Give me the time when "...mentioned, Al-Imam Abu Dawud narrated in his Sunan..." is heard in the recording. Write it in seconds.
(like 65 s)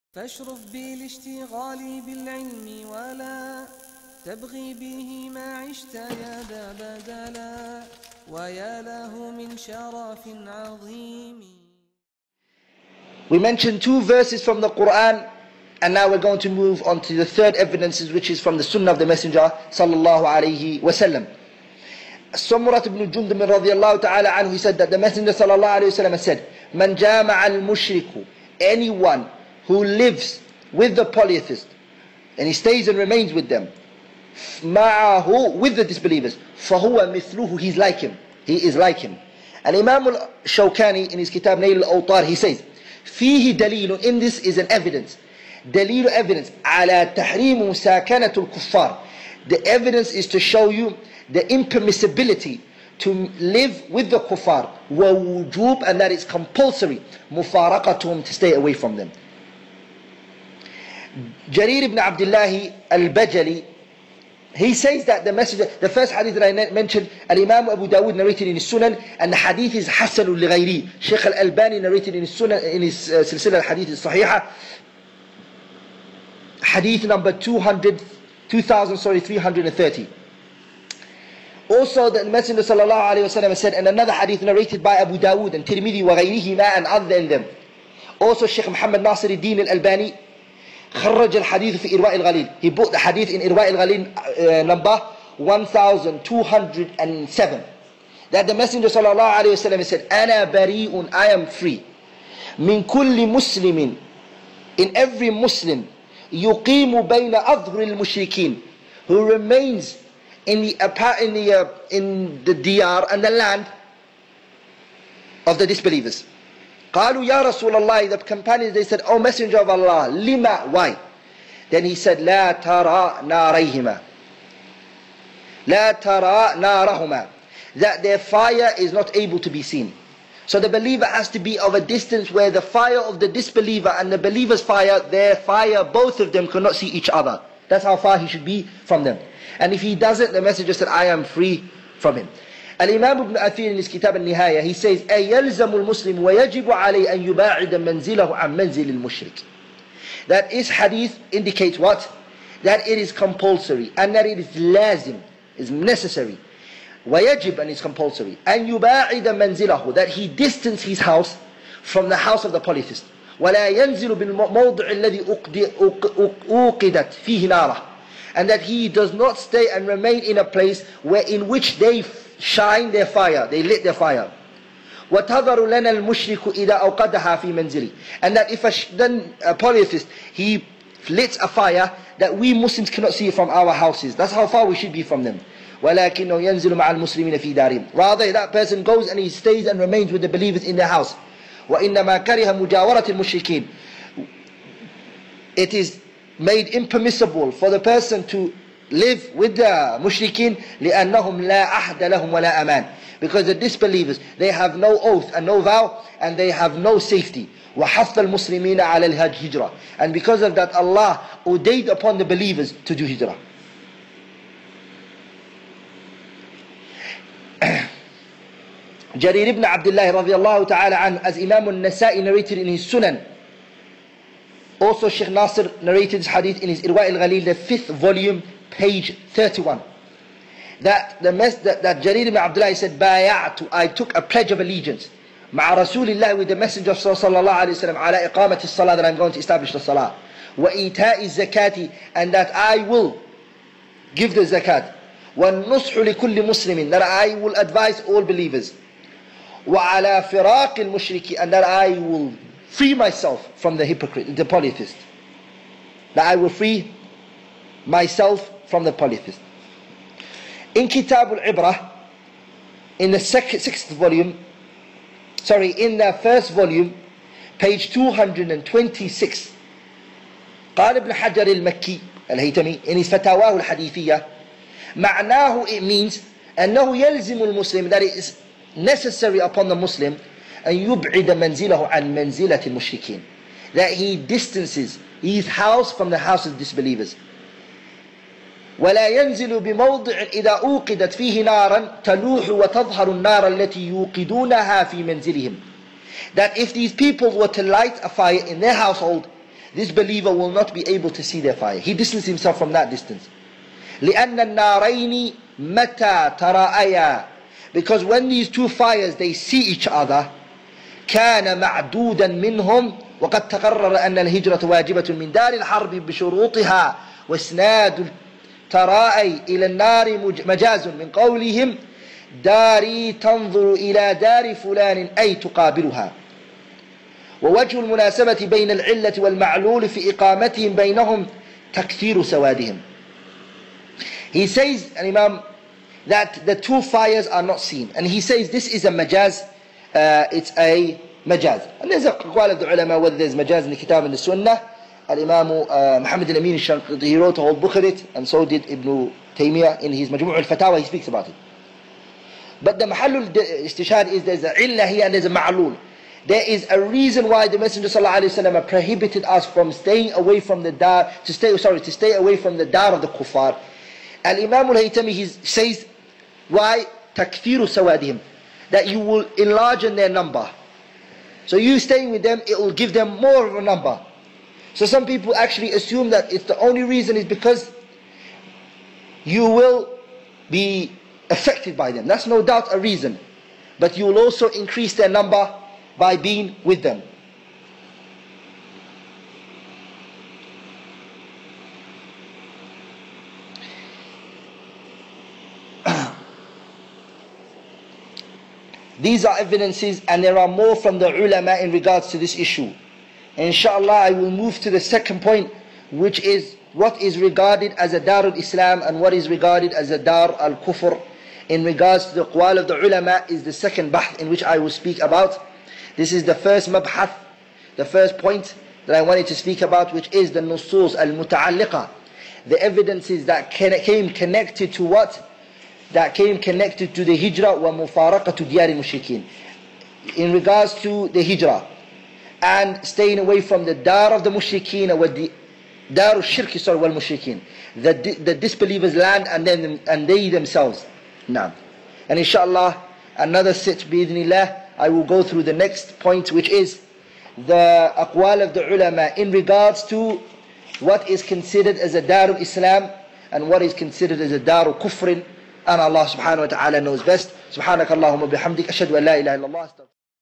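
66 s.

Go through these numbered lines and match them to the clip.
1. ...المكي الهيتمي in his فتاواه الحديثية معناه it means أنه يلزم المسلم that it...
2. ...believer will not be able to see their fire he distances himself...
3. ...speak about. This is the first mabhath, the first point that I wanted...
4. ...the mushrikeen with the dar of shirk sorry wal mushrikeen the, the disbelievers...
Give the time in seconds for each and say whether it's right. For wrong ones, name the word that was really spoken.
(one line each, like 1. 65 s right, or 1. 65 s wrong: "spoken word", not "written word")
1. 271 s right
2. 299 s right
3. 414 s right
4. 434 s right.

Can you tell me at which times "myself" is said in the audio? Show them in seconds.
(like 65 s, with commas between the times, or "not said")
252 s, 257 s.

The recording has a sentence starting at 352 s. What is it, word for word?
But the Mahallul al is there's a Ilahi and there's a ma'lul.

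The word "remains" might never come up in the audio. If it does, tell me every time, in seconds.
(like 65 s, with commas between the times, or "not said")
32 s, 109 s, 169 s, 189 s.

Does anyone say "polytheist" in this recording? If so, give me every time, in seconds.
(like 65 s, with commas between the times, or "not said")
31 s, 162 s, 179 s, 254 s, 258 s.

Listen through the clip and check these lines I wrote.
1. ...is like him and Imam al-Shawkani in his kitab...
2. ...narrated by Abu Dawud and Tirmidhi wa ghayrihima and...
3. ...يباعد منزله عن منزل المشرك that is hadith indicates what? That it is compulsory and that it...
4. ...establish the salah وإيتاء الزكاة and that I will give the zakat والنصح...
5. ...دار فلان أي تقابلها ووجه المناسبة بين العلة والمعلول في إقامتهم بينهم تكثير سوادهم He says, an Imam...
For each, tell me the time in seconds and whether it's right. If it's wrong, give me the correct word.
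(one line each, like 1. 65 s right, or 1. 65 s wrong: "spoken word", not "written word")
1. 38 s right
2. 84 s right
3. 147 s right
4. 239 s right
5. 324 s right.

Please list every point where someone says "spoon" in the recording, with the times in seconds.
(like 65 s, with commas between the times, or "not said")
not said.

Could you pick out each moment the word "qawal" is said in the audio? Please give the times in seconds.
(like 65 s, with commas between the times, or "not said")
342 s, 412 s.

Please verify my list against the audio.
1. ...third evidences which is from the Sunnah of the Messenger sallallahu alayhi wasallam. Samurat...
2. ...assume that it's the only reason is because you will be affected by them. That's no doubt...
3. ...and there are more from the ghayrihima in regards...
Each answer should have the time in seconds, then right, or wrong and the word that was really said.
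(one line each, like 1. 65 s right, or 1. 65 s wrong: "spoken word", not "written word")
1. 17 s right
2. 375 s right
3. 400 s wrong: "ulama", not "ghayrihima".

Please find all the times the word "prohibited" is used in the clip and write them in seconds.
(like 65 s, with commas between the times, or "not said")
358 s.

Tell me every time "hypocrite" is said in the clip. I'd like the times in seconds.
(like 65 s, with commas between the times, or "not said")
253 s.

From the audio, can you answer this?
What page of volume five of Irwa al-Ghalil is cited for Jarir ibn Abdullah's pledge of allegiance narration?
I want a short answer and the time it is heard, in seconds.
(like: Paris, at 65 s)
31, at 228 s.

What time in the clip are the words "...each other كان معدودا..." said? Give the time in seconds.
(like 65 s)
309 s.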